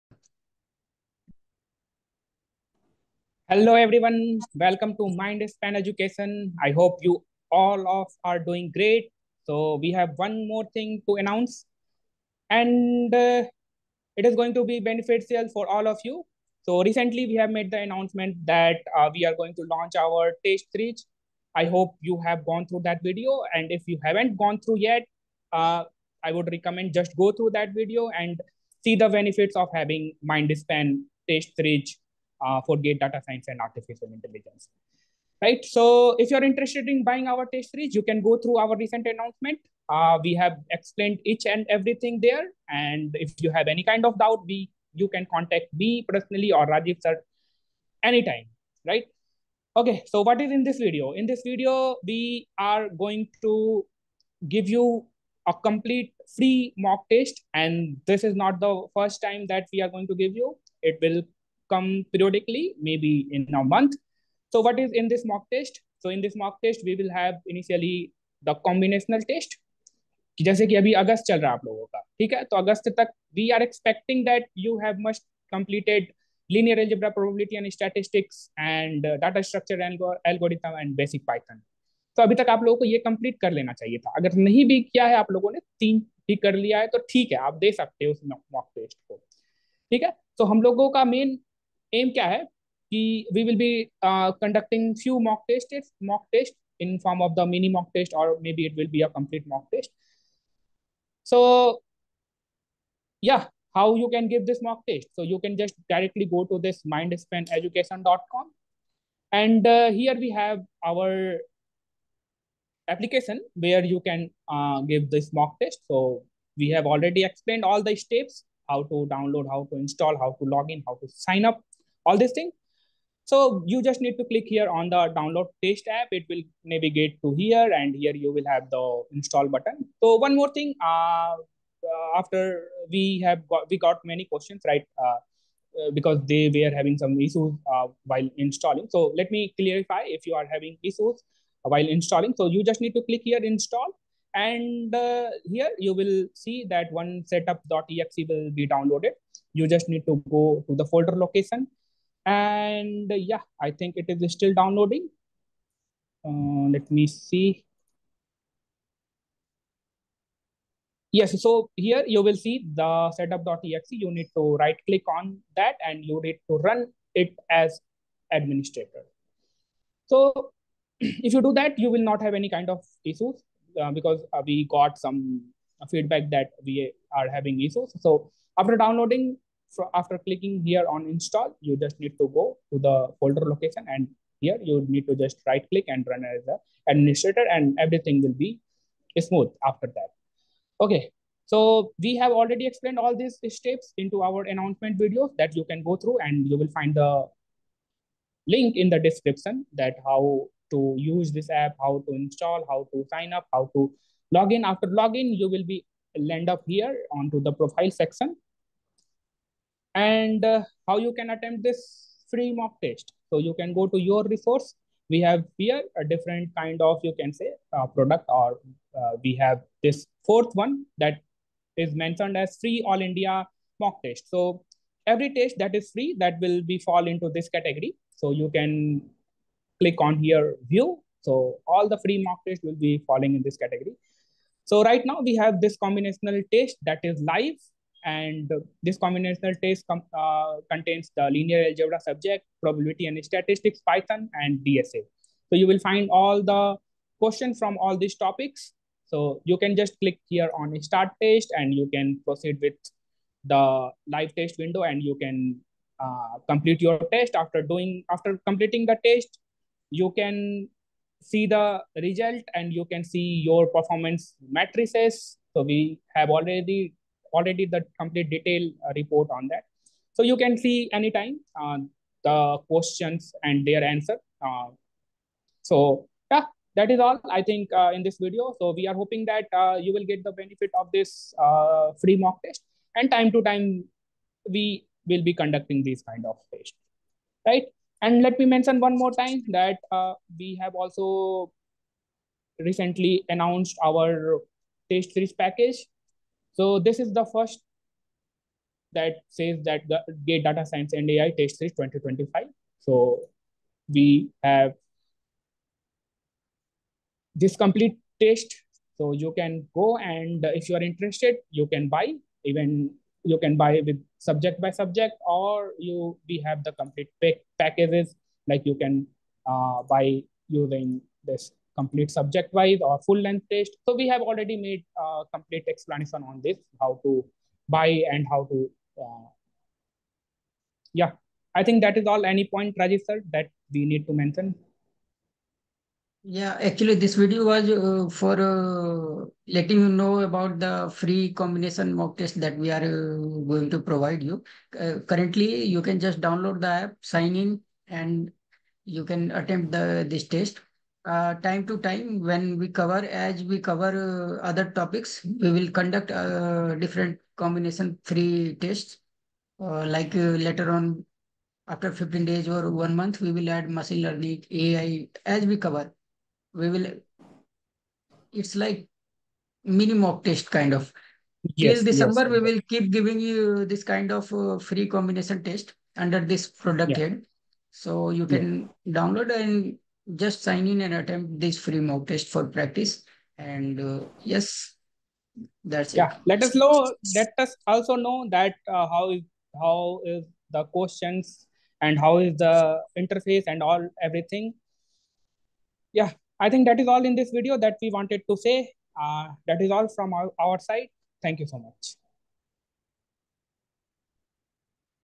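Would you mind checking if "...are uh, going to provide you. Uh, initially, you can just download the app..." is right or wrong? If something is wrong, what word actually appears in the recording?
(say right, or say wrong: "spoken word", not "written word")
wrong: "currently", not "initially".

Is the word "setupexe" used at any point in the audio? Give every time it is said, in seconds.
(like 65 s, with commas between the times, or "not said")
147 s, 163 s.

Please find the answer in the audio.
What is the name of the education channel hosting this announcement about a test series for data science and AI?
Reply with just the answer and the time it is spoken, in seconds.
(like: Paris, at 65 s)
Mind Span Education, at 5 s.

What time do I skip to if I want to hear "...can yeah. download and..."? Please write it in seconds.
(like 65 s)
378 s.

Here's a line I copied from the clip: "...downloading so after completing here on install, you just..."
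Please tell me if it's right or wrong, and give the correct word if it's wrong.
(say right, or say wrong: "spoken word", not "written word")
wrong: "clicking", not "completing".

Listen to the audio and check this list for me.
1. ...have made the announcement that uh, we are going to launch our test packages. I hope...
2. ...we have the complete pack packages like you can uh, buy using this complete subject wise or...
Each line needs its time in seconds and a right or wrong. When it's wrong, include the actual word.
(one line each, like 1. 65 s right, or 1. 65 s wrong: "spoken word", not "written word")
1. 17 s wrong: "series", not "packages"
2. 316 s right.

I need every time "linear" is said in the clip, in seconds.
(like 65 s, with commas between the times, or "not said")
76 s, 241 s.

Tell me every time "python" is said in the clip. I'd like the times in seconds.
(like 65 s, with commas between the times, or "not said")
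81 s, 243 s.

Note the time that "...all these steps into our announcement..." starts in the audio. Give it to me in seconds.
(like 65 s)
192 s.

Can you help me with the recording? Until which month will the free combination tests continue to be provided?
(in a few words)
December.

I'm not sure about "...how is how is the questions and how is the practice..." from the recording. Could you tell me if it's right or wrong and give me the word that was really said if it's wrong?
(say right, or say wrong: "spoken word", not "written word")
wrong: "interface", not "practice".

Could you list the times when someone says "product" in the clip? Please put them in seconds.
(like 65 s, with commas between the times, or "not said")
217 s, 376 s.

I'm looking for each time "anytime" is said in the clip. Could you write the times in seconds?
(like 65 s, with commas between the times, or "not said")
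48 s, 270 s.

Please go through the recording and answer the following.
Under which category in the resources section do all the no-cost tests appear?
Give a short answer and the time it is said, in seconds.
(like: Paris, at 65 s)
Free All India Mock Test, at 222 s.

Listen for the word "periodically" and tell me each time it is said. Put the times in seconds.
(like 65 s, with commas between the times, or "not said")
62 s.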